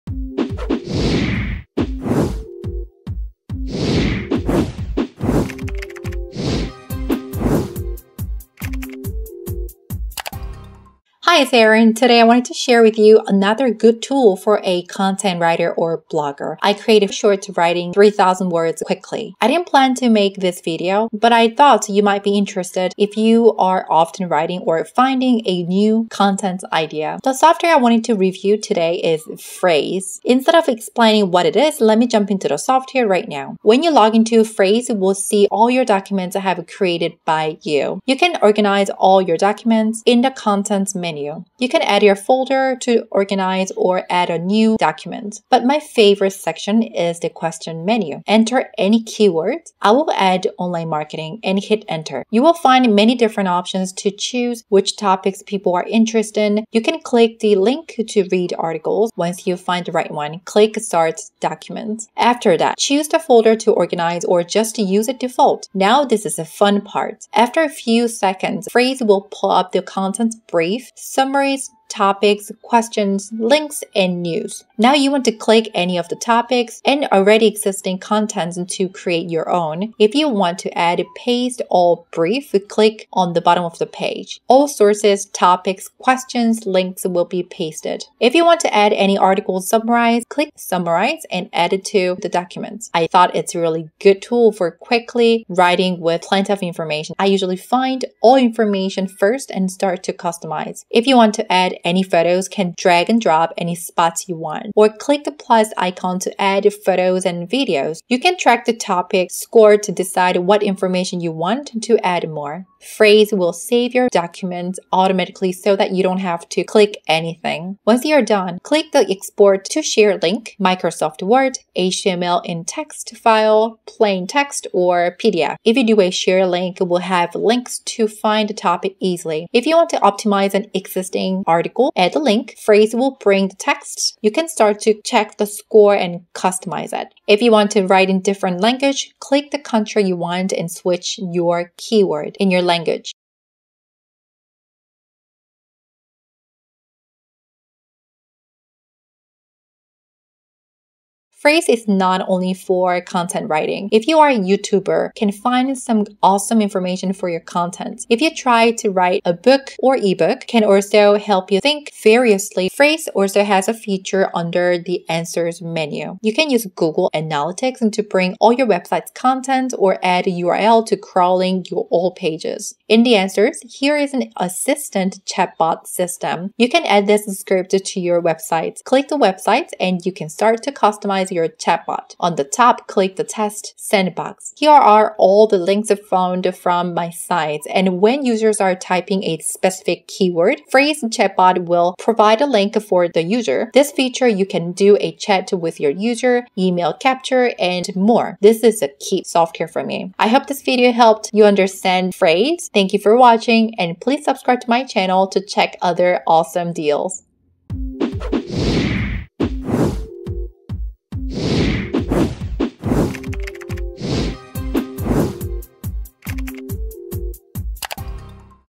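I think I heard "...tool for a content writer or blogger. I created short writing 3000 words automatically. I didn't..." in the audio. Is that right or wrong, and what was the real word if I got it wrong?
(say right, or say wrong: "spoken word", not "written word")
wrong: "quickly", not "automatically".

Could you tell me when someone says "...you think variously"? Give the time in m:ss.
2:41.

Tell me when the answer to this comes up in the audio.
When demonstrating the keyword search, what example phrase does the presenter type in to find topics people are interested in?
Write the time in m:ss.
0:50.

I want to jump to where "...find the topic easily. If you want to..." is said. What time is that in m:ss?
2:08.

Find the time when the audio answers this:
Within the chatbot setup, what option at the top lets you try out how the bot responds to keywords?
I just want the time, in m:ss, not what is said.
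3:03.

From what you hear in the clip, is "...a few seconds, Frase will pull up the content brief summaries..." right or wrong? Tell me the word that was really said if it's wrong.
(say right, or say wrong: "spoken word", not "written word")
right.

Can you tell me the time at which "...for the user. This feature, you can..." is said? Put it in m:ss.
3:12.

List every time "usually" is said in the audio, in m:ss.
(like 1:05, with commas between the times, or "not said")
1:37.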